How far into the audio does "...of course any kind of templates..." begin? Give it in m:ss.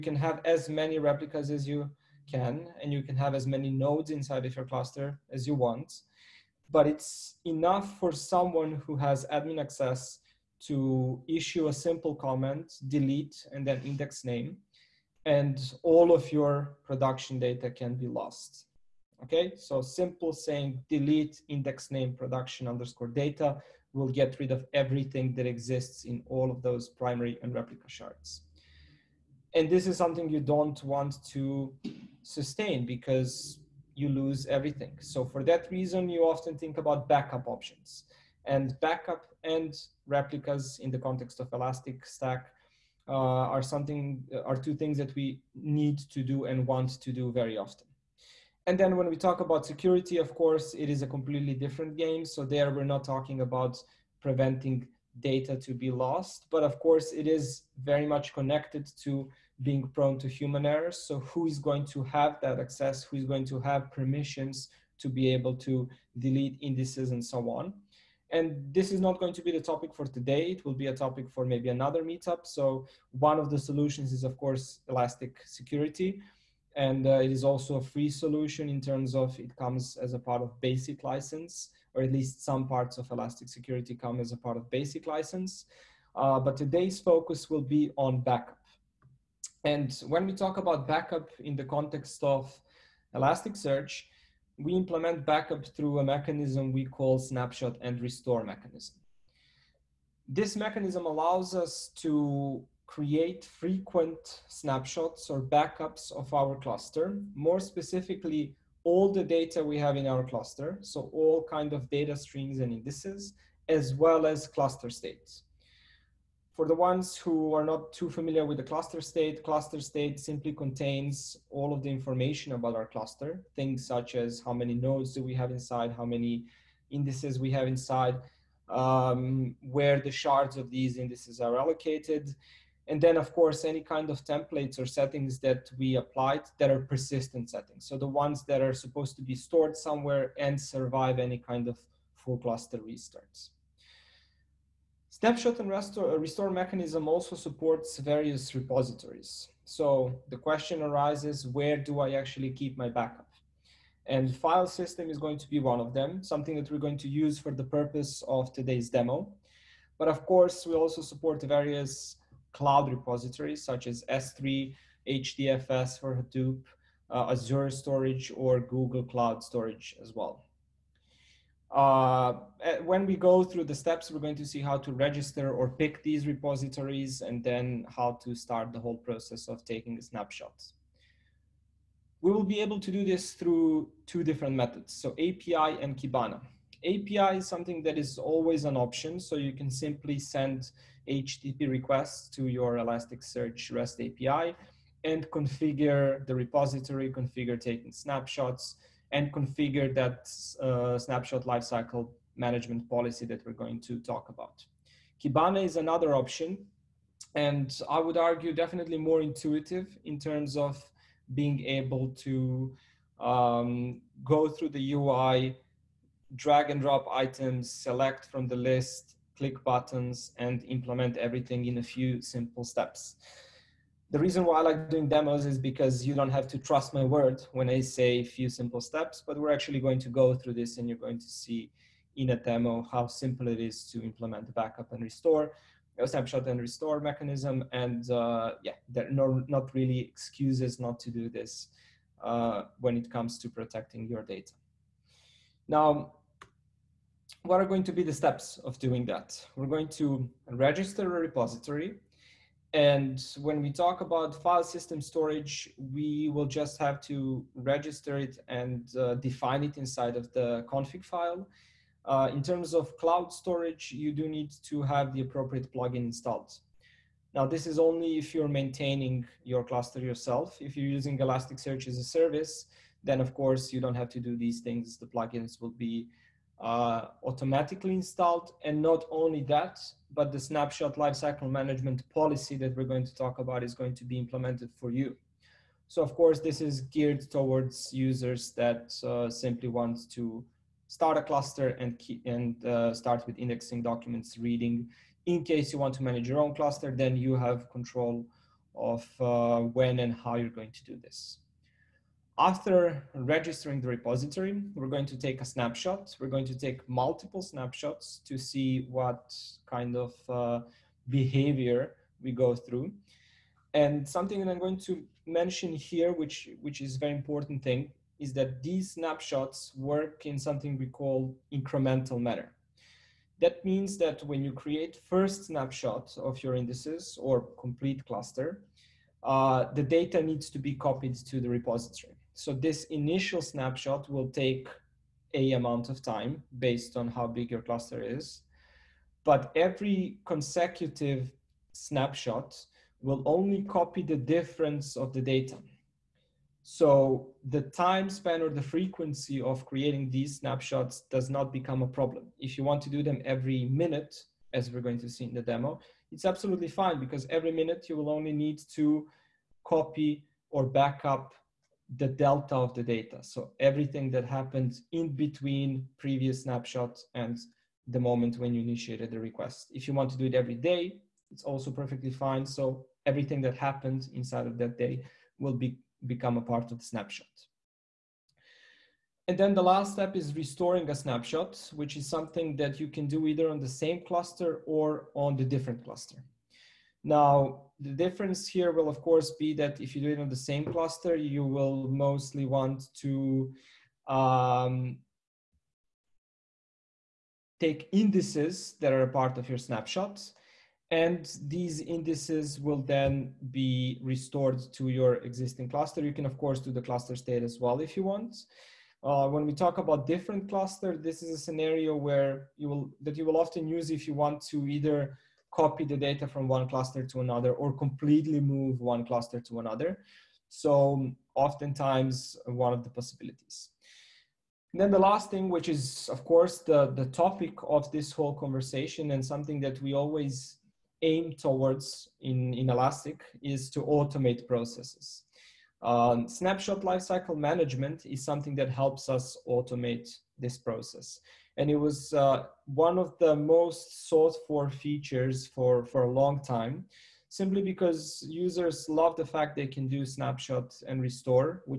2:13.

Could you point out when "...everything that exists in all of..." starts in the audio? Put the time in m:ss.
0:24.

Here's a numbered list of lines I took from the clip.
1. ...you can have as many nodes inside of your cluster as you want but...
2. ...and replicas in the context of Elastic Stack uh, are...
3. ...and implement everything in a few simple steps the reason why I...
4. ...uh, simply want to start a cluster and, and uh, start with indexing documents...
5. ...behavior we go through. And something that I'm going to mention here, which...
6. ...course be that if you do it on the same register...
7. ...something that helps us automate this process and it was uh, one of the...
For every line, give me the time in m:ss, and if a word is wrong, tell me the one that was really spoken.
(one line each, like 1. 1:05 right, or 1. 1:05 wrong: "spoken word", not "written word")
1. 0:02 right
2. 0:39 right
3. 3:40 right
4. 4:49 right
5. 5:11 right
6. 6:29 wrong: "cluster", not "register"
7. 7:18 right.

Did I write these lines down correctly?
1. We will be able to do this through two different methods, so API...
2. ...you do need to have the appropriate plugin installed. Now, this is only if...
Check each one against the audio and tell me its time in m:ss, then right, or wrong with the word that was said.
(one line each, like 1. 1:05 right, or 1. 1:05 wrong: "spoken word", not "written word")
1. 3:02 right
2. 4:23 right.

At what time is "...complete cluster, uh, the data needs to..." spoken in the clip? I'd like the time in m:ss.
5:27.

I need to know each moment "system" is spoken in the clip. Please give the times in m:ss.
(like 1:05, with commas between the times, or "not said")
2:34, 4:14.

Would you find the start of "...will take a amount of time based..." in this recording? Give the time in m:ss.
5:34.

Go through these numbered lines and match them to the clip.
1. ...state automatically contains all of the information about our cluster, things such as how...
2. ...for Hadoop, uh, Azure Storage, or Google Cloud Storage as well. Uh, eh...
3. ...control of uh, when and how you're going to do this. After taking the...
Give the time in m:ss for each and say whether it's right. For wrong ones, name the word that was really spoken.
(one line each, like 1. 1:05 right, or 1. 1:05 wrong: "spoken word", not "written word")
1. 1:59 wrong: "simply", not "automatically"
2. 2:46 right
3. 4:57 wrong: "registering", not "taking".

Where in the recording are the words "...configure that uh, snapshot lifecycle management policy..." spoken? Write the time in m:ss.
3:19.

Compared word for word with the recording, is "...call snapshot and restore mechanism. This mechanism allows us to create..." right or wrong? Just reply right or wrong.
right.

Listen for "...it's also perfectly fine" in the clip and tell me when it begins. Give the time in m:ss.
6:11.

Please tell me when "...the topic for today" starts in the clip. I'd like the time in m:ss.
1:09.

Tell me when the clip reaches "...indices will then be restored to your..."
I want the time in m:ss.
6:41.